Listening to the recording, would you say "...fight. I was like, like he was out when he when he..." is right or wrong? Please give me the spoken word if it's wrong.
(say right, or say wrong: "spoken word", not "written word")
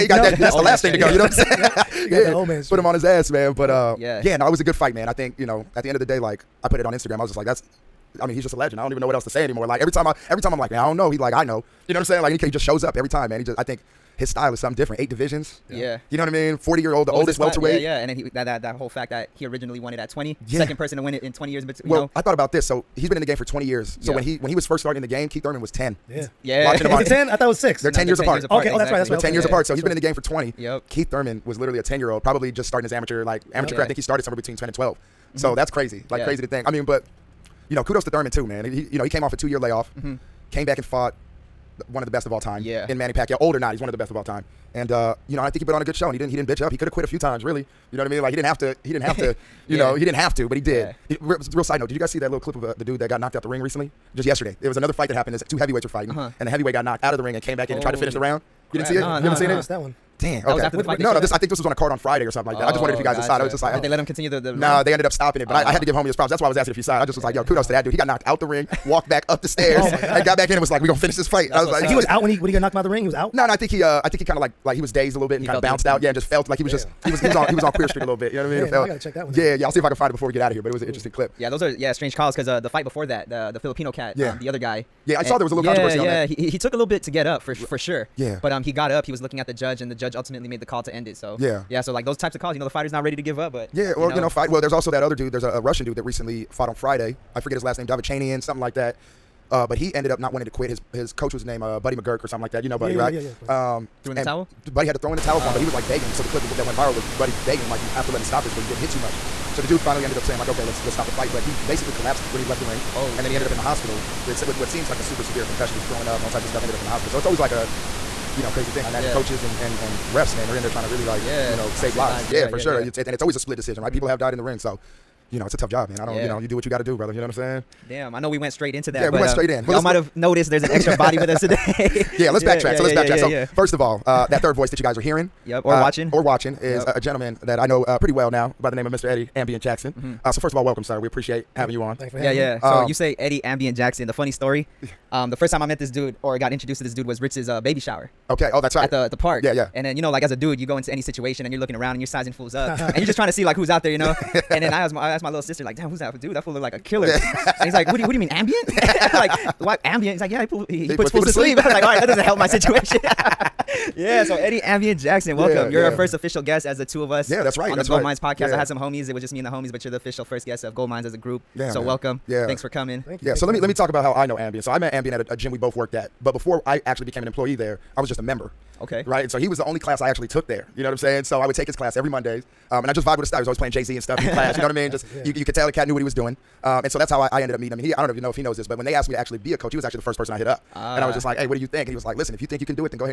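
right.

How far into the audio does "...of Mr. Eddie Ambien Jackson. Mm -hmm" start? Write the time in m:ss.
2:18.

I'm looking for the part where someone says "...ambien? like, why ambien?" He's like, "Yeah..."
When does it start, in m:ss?
2:38.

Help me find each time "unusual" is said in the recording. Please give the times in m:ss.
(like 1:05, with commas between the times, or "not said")
not said.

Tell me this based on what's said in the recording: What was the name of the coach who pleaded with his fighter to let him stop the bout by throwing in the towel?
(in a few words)
Buddy McGirt.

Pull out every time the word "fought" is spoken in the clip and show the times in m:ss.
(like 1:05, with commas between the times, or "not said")
0:40, 1:36.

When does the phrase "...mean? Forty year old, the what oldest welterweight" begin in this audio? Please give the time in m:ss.
0:16.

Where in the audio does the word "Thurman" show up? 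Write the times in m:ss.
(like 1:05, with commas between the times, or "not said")
0:25, 0:31, 0:38.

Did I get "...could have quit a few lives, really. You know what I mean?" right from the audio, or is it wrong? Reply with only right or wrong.
wrong.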